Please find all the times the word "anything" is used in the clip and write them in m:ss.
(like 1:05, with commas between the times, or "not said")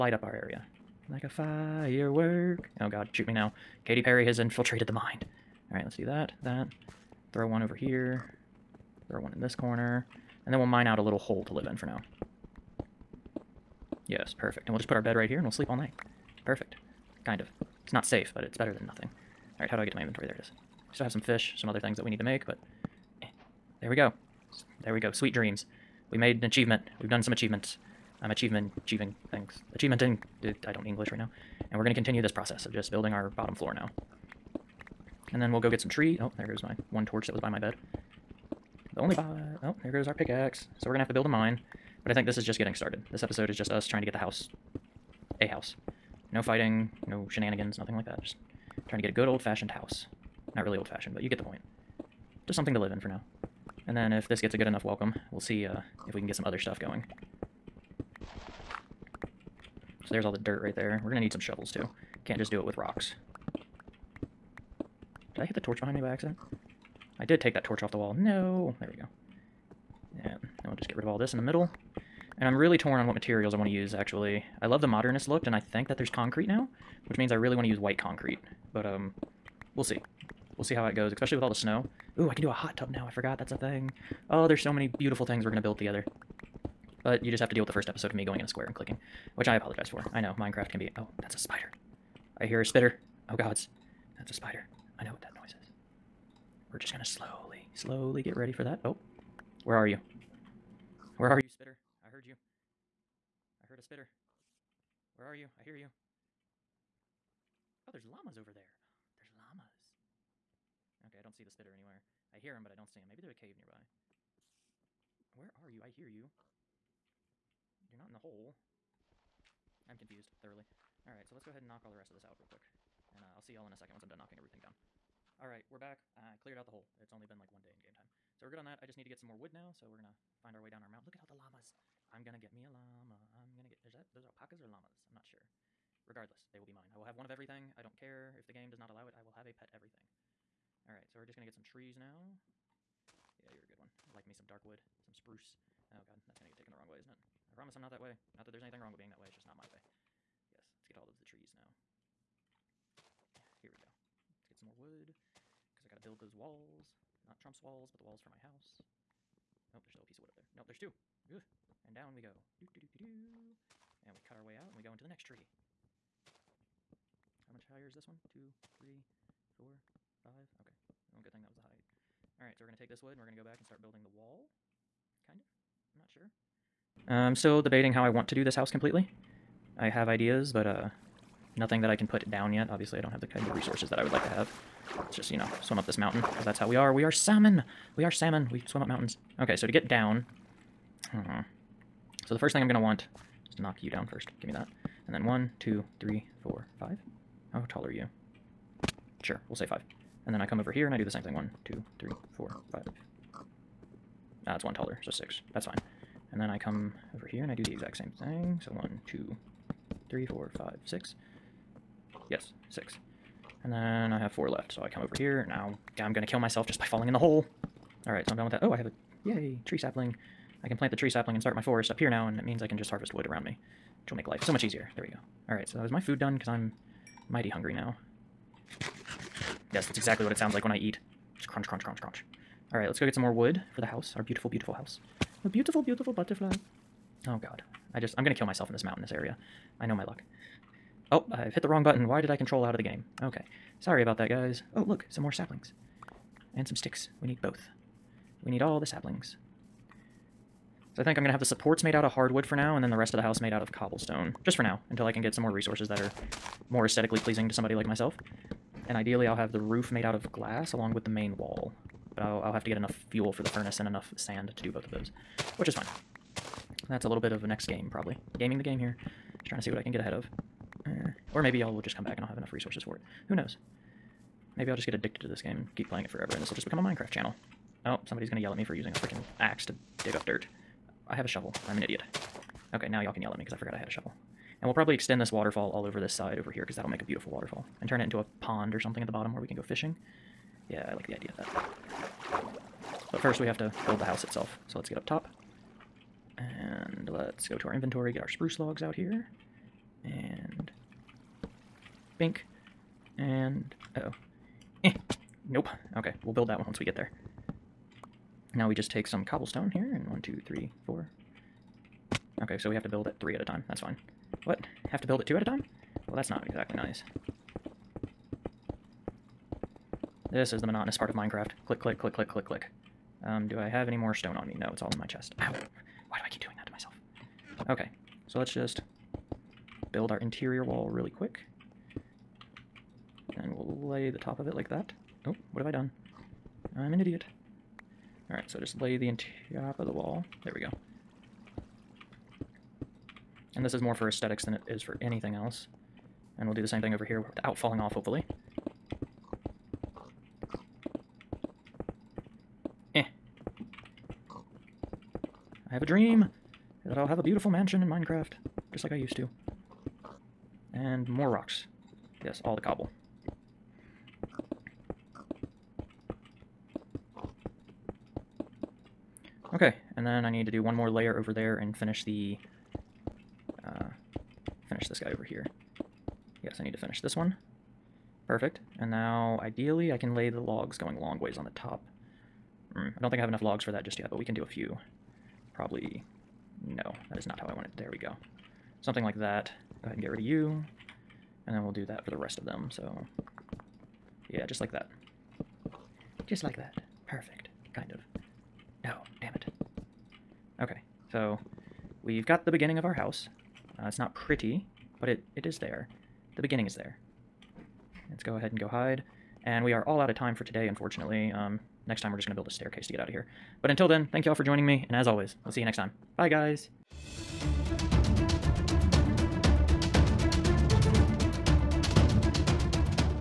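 2:28, 5:45.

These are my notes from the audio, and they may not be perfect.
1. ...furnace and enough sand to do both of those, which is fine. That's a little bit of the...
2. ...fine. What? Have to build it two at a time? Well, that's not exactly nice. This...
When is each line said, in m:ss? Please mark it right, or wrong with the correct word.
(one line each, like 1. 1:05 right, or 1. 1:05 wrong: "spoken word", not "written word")
1. 4:23 right
2. 5:13 right.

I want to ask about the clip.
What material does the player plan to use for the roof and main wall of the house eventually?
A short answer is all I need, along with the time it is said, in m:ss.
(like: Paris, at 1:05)
Glass, at 4:20.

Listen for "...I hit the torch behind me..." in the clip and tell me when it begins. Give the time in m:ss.
1:05.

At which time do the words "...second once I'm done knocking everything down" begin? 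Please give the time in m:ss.
2:03.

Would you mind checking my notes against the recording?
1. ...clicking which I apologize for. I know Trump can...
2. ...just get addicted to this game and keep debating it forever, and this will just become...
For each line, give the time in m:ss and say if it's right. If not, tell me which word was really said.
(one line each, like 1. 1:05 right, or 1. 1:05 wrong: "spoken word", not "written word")
1. 1:28 wrong: "Minecraft", not "Trump"
2. 4:34 wrong: "playing", not "debating".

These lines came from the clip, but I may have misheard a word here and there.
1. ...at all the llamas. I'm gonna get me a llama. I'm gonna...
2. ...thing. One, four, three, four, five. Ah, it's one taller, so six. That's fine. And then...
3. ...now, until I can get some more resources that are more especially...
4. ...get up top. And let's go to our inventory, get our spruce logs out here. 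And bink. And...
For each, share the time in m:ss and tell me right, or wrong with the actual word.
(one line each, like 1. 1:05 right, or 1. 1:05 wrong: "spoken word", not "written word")
1. 2:11 right
2. 3:21 wrong: "two", not "four"
3. 4:14 wrong: "aesthetically", not "especially"
4. 4:54 right.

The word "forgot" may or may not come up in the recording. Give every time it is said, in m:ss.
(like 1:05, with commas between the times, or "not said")
1:23, 4:43.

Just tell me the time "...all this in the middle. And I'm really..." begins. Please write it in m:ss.
1:11.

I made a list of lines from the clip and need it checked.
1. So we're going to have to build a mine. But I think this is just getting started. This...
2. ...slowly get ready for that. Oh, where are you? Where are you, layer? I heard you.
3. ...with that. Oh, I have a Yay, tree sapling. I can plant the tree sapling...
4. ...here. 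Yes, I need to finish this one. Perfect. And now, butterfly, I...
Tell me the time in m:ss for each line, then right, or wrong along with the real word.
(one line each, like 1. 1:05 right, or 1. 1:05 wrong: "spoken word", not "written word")
1. 0:40 right
2. 1:37 wrong: "spitter", not "layer"
3. 3:38 right
4. 6:15 wrong: "ideally", not "butterfly".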